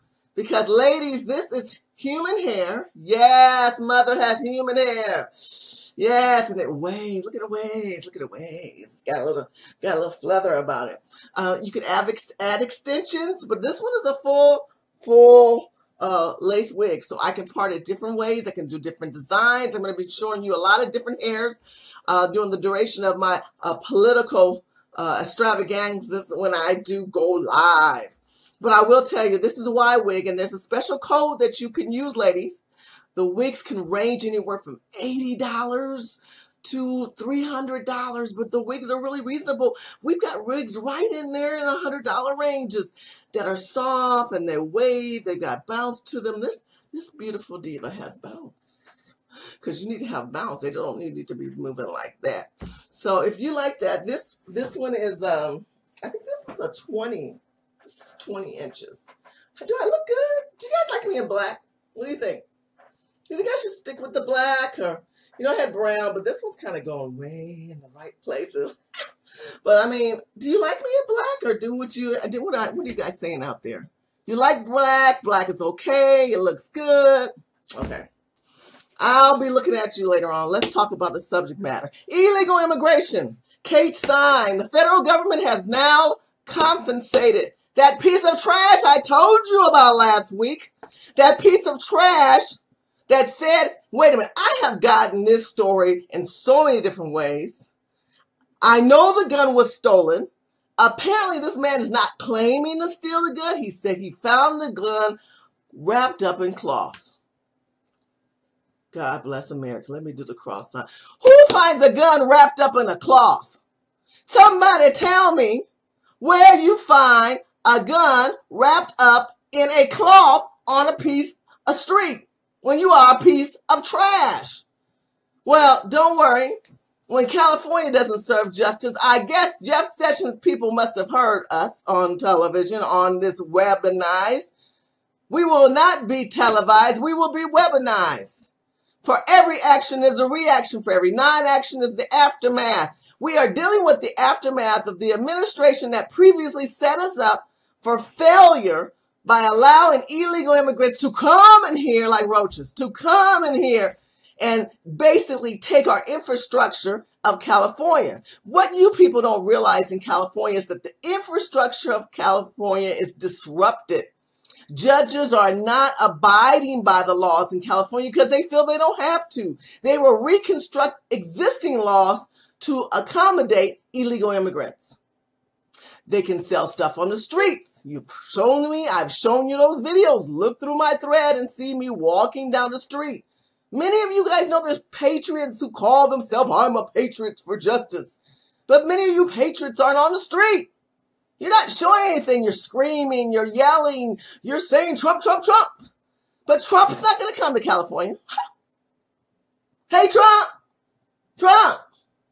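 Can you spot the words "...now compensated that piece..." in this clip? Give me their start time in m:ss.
1:25.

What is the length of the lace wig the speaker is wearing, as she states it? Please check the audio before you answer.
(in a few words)
20 inches.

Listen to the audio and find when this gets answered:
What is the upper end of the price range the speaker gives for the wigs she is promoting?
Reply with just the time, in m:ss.
0:37.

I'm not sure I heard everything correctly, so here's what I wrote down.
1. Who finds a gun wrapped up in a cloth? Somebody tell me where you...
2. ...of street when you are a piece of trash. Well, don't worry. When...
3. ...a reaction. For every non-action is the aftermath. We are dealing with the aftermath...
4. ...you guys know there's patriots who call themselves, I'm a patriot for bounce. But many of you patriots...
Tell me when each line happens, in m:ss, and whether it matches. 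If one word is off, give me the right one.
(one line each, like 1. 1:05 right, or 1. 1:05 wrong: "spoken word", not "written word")
1. 1:51 right
2. 2:01 right
3. 2:20 right
4. 3:04 wrong: "justice", not "bounce".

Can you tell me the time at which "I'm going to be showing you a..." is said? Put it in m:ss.
0:19.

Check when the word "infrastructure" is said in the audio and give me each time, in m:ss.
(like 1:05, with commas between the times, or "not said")
2:36, 2:41.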